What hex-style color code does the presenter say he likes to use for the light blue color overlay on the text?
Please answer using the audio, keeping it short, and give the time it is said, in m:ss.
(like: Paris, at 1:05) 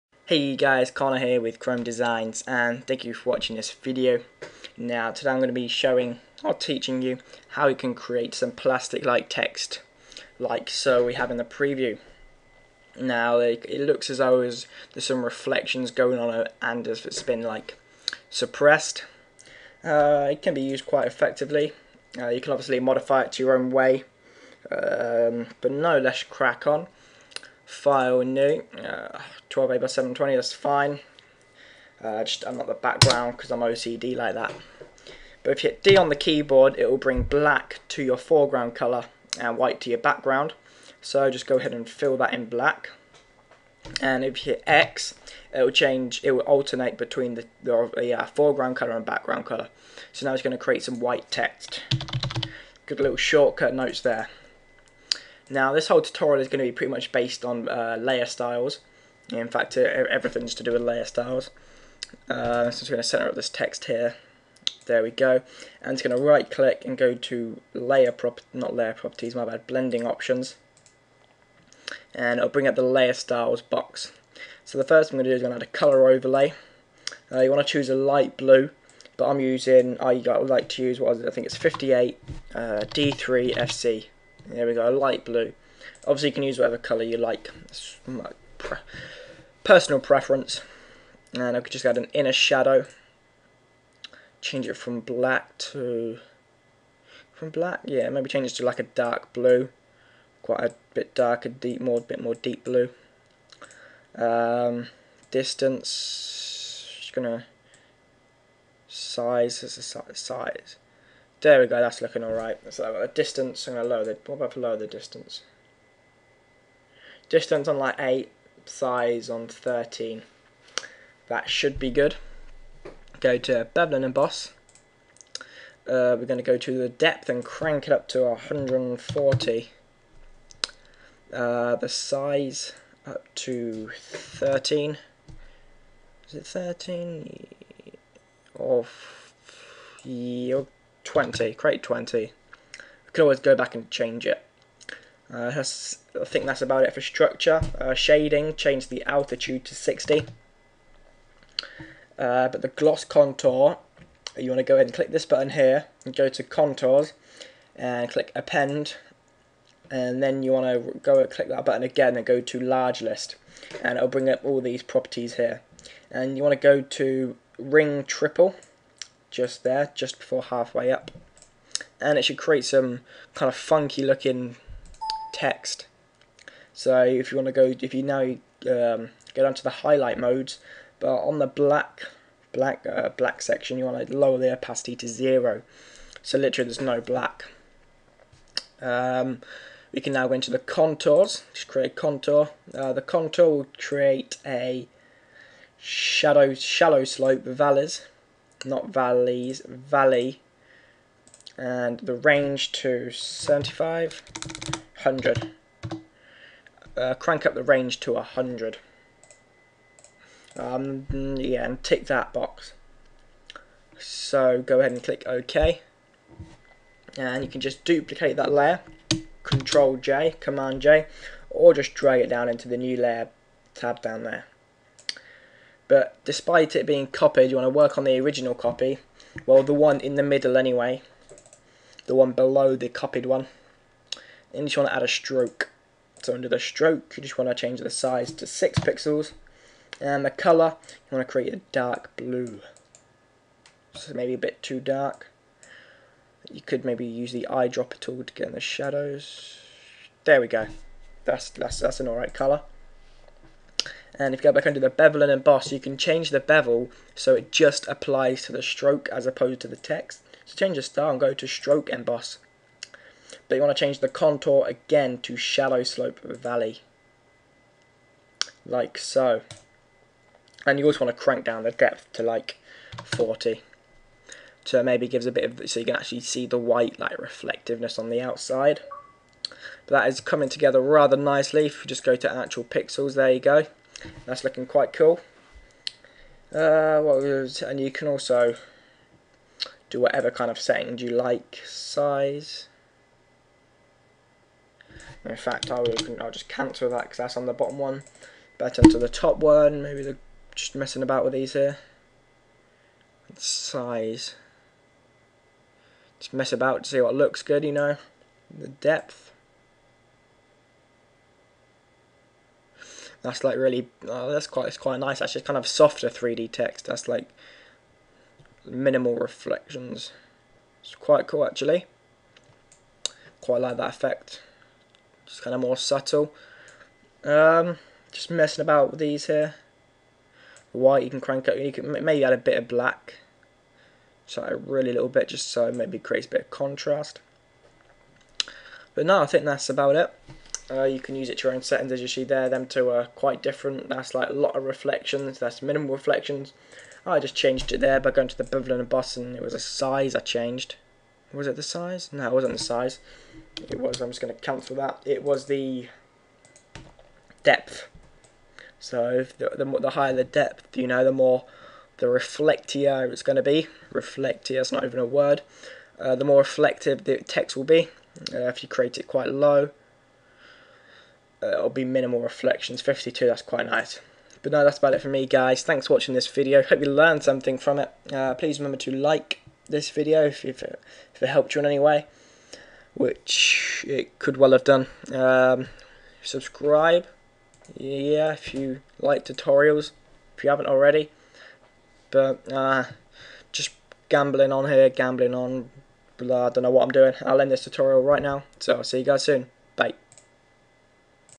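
58D3FC, at 1:21.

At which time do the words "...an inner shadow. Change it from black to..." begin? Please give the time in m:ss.
1:31.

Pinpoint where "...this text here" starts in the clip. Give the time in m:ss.
1:03.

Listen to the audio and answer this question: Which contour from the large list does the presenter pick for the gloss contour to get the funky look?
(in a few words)
Ring triple.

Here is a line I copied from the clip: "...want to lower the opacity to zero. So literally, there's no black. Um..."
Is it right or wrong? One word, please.
right.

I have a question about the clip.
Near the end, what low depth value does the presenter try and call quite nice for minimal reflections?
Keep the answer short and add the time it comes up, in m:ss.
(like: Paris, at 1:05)
52, at 6:12.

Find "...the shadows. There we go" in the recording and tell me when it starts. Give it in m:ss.
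4:08.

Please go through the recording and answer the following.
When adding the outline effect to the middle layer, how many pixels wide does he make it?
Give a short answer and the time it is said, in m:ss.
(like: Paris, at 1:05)
6 pixels, at 3:58.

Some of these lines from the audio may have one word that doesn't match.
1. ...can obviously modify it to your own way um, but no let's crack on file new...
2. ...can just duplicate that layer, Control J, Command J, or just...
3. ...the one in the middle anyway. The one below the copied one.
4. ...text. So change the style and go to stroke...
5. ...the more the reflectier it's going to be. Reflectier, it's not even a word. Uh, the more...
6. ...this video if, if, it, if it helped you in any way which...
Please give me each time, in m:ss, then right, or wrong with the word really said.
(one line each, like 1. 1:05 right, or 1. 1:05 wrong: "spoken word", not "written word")
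1. 0:22 right
2. 3:37 right
3. 3:49 right
4. 4:19 right
5. 6:01 right
6. 6:19 right.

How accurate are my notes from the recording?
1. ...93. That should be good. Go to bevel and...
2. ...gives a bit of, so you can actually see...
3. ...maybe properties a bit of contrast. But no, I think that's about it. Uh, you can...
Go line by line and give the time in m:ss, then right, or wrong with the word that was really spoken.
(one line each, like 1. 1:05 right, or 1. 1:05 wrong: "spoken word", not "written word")
1. 1:59 wrong: "13", not "93"
2. 4:35 right
3. 5:35 wrong: "creates", not "properties".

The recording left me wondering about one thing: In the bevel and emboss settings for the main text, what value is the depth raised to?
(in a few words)
140.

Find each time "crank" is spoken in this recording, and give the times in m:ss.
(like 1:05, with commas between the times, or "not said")
2:07, 3:27, 4:31, 5:31.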